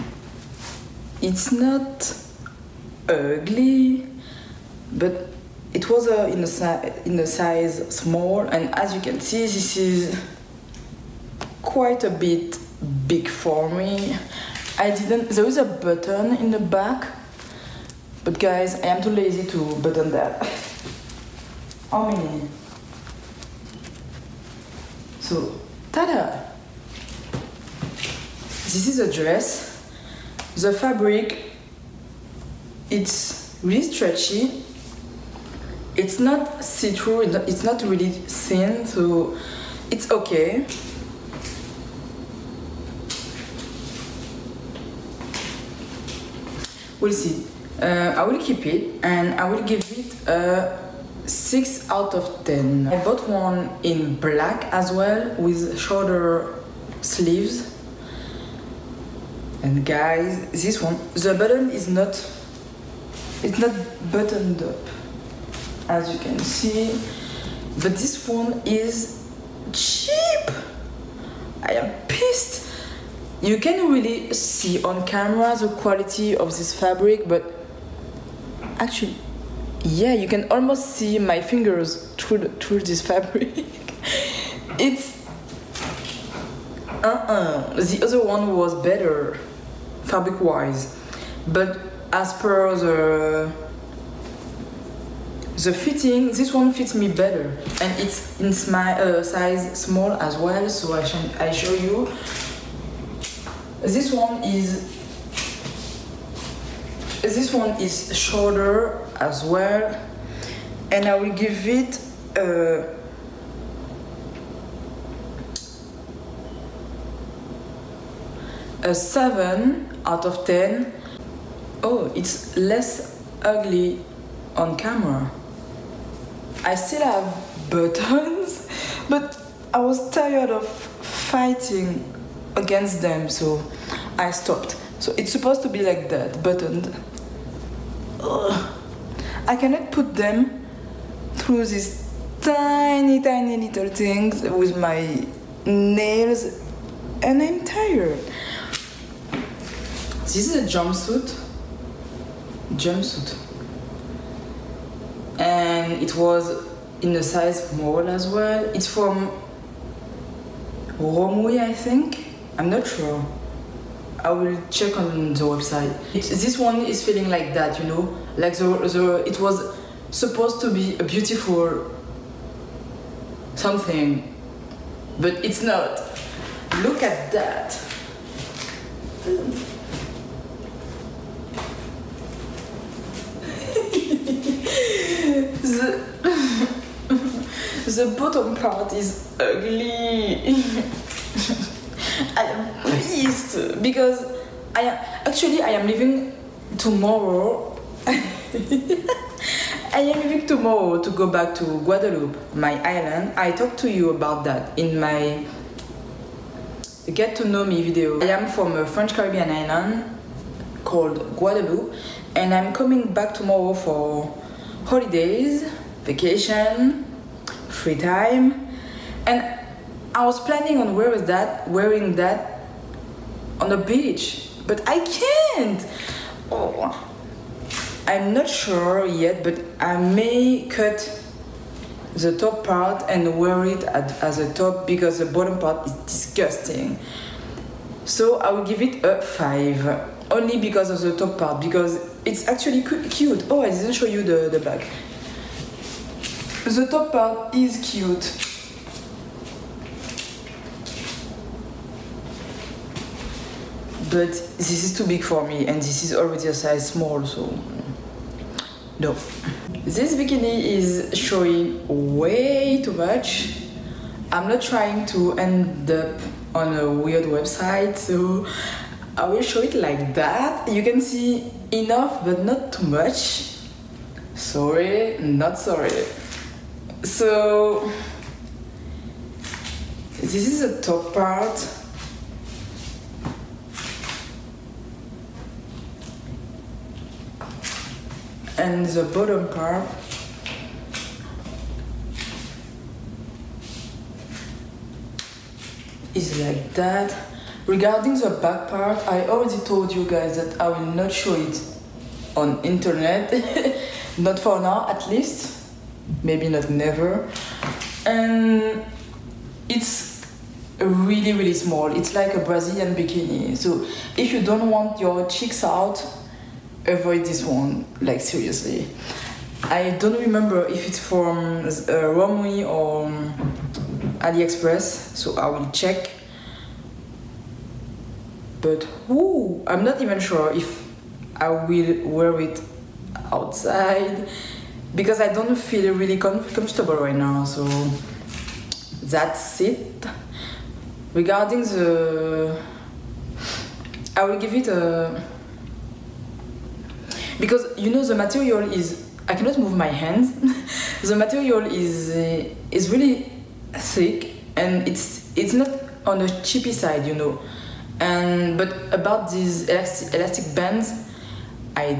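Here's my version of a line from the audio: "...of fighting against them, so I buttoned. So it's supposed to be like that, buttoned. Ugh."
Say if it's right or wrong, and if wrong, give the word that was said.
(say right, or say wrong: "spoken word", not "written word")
wrong: "stopped", not "buttoned".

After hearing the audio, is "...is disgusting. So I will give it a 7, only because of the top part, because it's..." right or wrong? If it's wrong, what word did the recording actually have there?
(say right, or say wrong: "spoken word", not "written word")
wrong: "5", not "7".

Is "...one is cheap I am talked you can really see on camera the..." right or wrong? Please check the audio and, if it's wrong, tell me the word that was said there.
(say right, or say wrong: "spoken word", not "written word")
wrong: "pissed", not "talked".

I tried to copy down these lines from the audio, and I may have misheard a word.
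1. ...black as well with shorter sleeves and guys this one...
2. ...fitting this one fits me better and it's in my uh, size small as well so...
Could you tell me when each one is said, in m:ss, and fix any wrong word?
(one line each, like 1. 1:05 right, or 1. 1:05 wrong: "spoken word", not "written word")
1. 0:54 right
2. 1:35 right.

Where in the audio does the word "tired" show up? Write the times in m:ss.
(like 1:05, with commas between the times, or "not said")
2:10, 2:27.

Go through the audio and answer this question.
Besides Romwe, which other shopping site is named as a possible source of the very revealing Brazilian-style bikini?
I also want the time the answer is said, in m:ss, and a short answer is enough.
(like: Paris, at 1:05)
AliExpress, at 5:24.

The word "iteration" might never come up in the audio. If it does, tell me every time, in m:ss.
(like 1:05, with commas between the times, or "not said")
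not said.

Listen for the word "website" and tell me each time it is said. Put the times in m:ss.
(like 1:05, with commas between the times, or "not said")
2:45, 4:27.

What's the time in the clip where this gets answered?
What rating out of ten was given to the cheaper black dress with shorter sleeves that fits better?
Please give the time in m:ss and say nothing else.
1:58.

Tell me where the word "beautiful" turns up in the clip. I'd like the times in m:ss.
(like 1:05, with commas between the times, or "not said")
2:51.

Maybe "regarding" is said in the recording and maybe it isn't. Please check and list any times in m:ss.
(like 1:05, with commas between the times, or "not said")
4:57, 5:41.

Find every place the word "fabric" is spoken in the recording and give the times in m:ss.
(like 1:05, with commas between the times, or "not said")
0:30, 1:16, 1:23, 1:30.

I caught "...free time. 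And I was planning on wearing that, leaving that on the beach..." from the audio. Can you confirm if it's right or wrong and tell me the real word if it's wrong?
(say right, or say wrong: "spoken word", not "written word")
wrong: "wearing", not "leaving".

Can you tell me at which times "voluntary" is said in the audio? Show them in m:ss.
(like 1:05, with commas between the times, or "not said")
not said.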